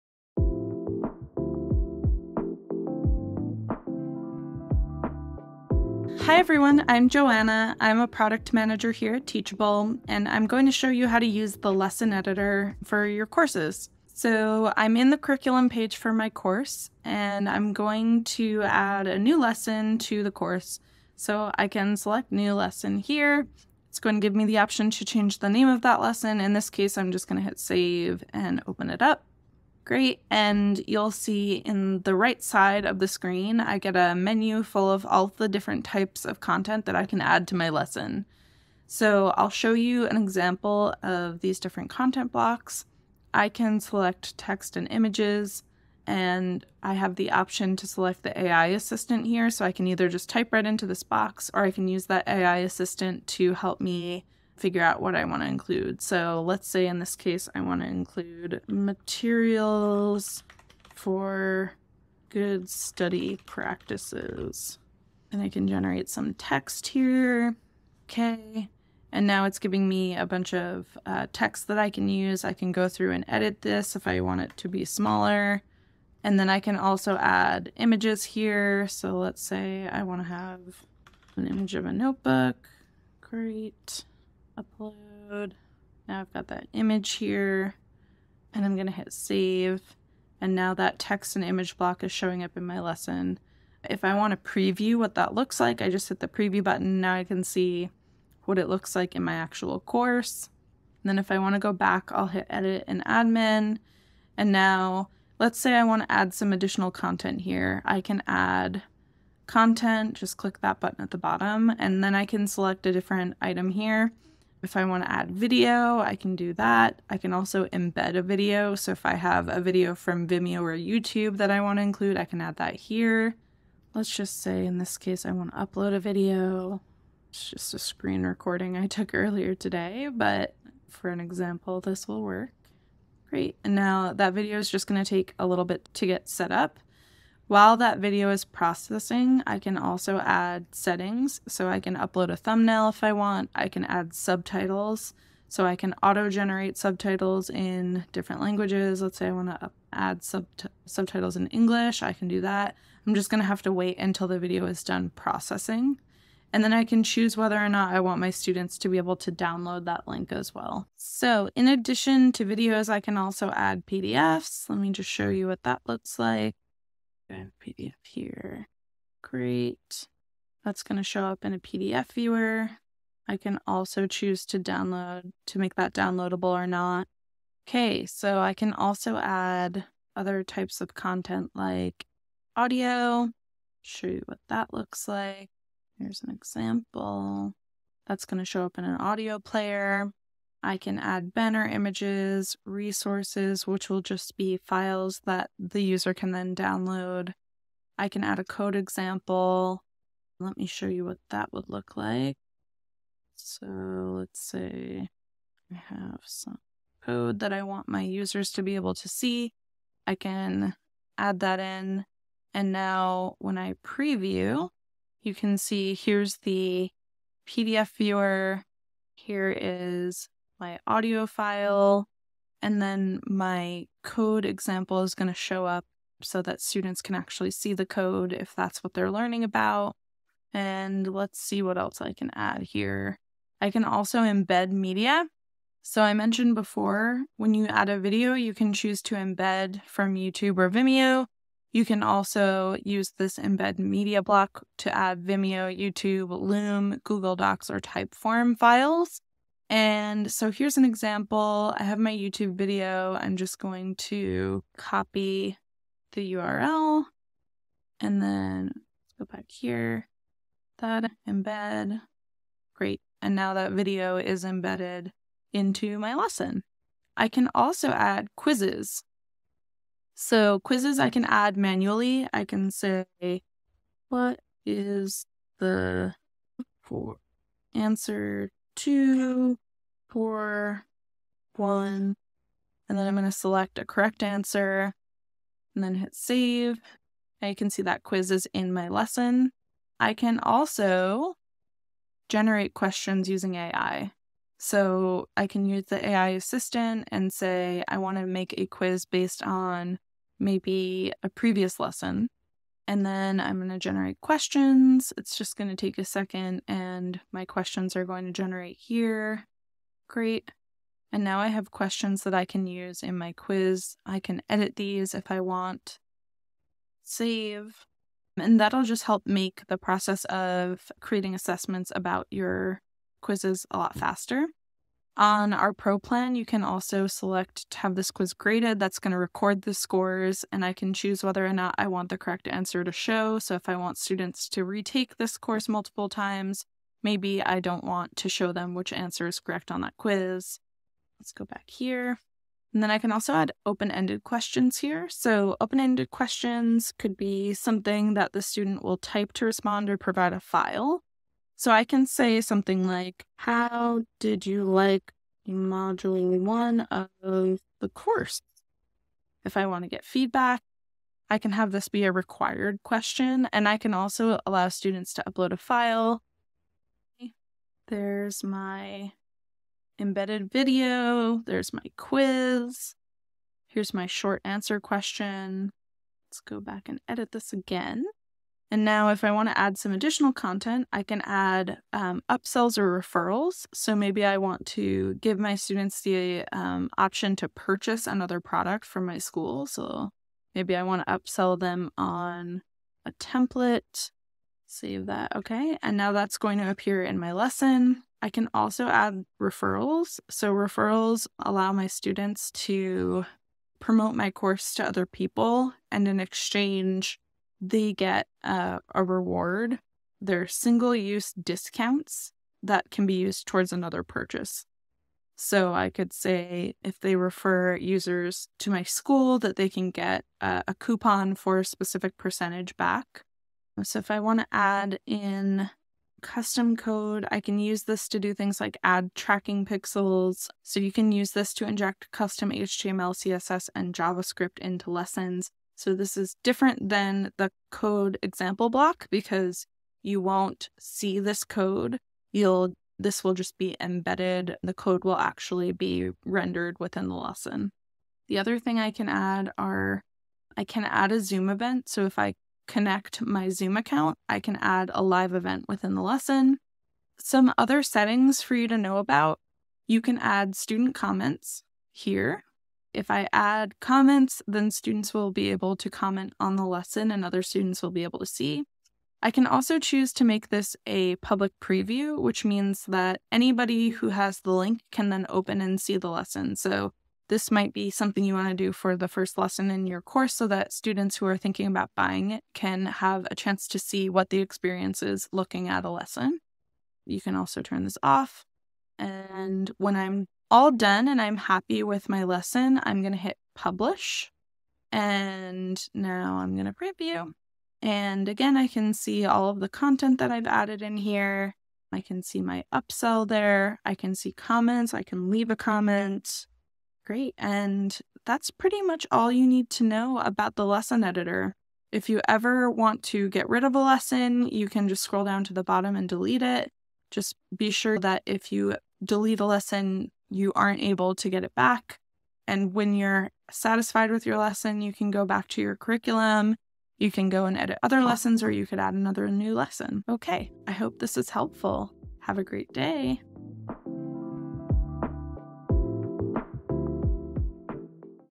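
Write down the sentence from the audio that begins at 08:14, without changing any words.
And now I'm going to preview.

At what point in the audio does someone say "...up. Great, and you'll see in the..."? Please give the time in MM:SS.
00:29.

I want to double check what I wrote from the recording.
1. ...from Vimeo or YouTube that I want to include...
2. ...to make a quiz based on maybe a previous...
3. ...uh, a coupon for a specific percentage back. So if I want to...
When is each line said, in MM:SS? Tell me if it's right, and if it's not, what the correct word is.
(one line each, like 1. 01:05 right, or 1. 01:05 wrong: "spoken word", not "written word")
1. 01:59 right
2. 04:58 right
3. 07:00 right.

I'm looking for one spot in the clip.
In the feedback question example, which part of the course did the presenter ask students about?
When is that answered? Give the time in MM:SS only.
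05:55.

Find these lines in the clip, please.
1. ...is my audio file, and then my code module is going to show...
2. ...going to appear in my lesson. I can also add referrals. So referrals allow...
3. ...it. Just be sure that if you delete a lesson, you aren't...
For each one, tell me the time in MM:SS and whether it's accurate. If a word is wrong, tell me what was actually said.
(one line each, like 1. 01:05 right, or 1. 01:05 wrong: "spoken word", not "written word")
1. 03:39 wrong: "example", not "module"
2. 06:36 right
3. 08:36 right.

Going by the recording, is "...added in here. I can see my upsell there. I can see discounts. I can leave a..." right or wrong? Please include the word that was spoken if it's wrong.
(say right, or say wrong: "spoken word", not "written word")
wrong: "comments", not "discounts".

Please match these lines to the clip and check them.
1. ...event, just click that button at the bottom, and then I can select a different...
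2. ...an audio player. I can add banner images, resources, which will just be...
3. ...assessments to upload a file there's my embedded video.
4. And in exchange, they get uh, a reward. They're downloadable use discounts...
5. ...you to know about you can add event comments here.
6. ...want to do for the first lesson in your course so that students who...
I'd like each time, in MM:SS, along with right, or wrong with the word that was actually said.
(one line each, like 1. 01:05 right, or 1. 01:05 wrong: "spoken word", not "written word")
1. 01:49 wrong: "content", not "event"
2. 03:08 right
3. 06:04 wrong: "students", not "assessments"
4. 06:45 wrong: "single", not "downloadable"
5. 07:38 wrong: "student", not "event"
6. 07:58 right.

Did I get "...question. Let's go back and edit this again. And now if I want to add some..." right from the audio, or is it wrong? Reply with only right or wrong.
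right.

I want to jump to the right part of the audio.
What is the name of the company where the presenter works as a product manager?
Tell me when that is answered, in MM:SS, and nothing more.
00:09.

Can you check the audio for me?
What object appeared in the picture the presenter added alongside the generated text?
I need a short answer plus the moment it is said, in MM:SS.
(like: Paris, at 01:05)
a notebook, at 01:21.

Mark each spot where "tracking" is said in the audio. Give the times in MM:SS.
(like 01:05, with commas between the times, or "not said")
07:09.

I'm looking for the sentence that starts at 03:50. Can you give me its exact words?
And let's see what else I can add here.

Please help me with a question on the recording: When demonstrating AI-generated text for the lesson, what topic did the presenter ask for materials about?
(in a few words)
good study practices.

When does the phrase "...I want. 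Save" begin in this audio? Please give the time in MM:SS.
05:15.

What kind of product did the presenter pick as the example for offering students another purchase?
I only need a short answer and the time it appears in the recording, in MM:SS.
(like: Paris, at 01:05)
a template, at 06:33.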